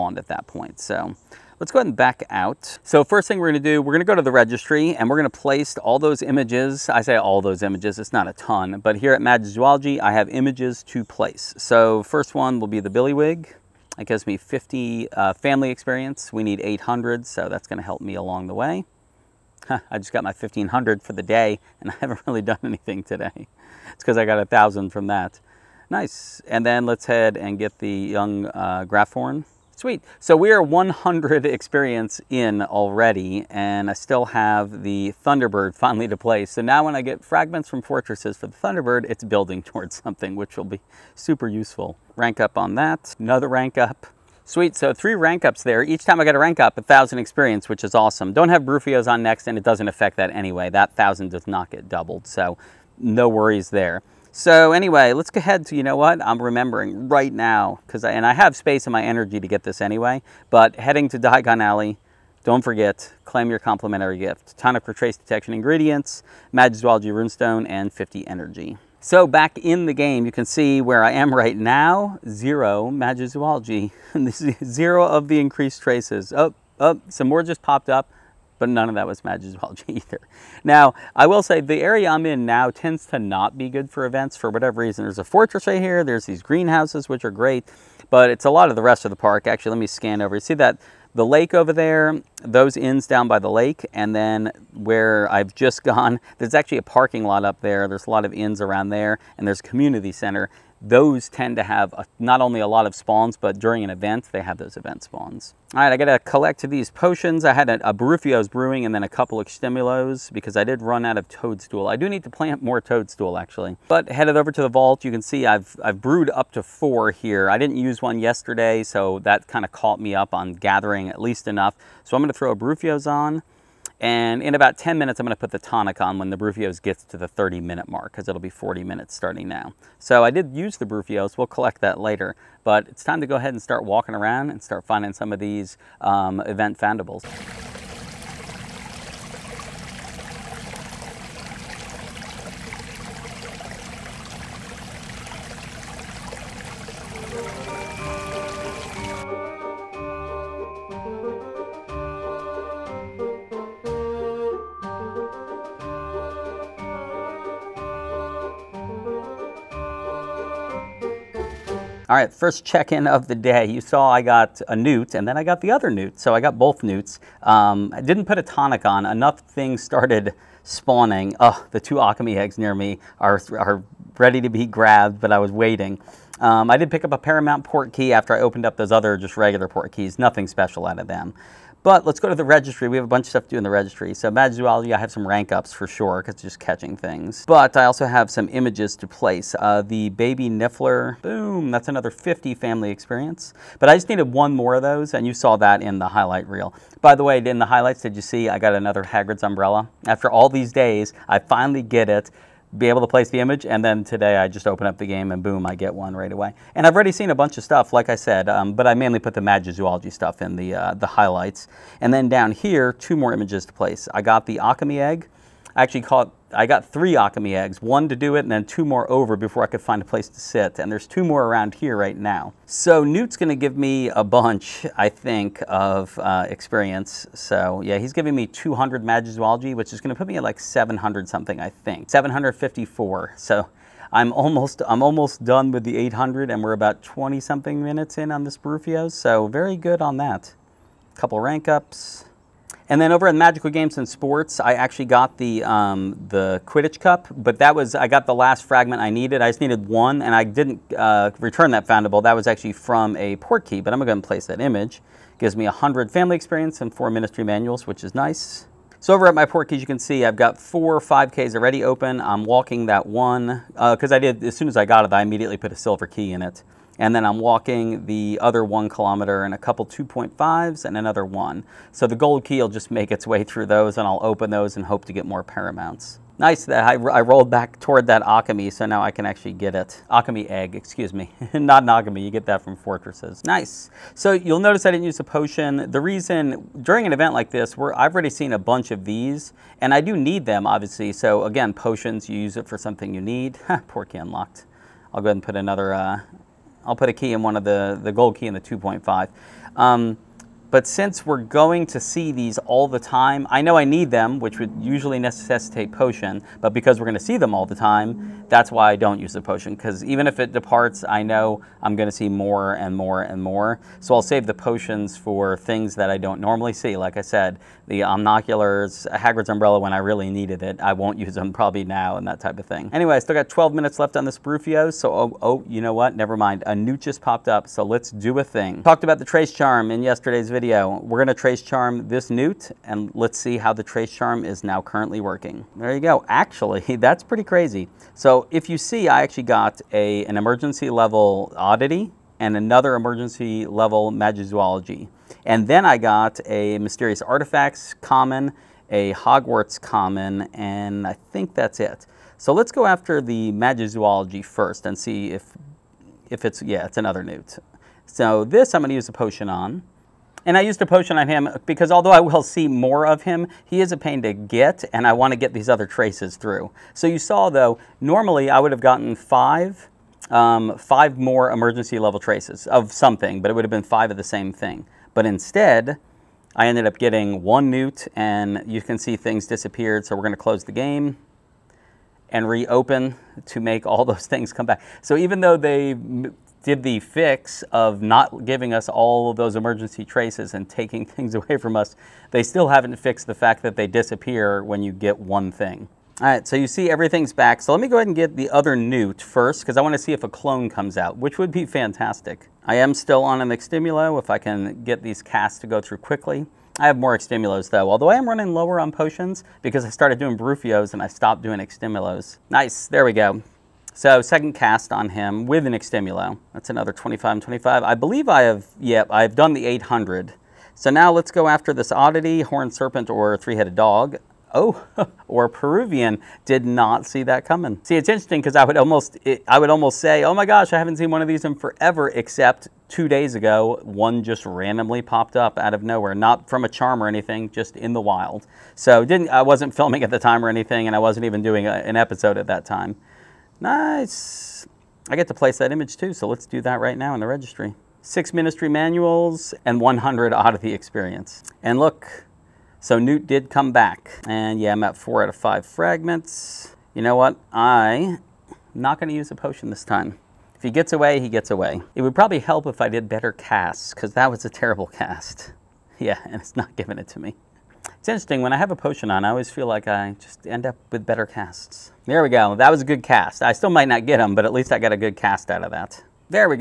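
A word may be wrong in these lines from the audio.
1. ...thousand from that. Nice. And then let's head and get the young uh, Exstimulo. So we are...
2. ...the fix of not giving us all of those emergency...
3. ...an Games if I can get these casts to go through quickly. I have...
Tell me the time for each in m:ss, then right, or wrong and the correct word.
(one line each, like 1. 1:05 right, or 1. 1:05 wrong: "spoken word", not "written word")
1. 0:24 wrong: "Sweet", not "Exstimulo"
2. 6:26 right
3. 6:43 wrong: "Exstimulo", not "Games".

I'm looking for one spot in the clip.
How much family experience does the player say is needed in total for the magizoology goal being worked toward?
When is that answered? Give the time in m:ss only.
0:16.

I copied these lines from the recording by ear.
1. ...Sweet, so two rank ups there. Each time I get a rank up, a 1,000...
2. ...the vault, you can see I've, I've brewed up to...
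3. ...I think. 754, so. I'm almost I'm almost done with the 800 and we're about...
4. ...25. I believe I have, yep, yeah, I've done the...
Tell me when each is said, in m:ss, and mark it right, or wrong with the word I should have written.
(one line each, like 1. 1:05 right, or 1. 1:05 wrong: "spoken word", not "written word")
1. 0:44 wrong: "three", not "two"
2. 1:54 right
3. 3:51 right
4. 6:57 right.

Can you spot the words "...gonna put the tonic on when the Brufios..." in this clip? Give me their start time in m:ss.
2:05.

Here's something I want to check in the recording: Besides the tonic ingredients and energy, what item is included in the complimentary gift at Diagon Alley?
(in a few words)
Magic's Rune Runestone.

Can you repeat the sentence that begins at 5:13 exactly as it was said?
So I'll save the potions for things that I don't normally see.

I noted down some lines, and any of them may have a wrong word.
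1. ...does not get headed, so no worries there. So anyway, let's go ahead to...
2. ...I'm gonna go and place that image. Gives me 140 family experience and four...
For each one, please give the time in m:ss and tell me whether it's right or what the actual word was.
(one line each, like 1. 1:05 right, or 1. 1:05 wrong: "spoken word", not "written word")
1. 0:51 wrong: "doubled", not "headed"
2. 4:13 wrong: "100", not "140".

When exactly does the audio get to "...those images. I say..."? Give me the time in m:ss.
0:05.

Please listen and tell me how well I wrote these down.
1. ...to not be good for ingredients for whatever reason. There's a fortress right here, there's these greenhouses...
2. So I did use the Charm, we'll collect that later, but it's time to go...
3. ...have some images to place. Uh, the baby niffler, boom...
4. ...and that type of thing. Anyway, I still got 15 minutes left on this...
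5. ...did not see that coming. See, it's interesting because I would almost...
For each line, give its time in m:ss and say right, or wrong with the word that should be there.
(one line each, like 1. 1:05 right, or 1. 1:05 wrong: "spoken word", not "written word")
1. 1:23 wrong: "events", not "ingredients"
2. 2:09 wrong: "Brufios", not "Charm"
3. 3:08 right
4. 5:22 wrong: "12", not "15"
5. 7:06 right.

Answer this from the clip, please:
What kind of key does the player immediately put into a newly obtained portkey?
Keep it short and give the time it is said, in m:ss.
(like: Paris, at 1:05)
silver key, at 4:25.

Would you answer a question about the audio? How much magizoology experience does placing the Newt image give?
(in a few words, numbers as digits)
200.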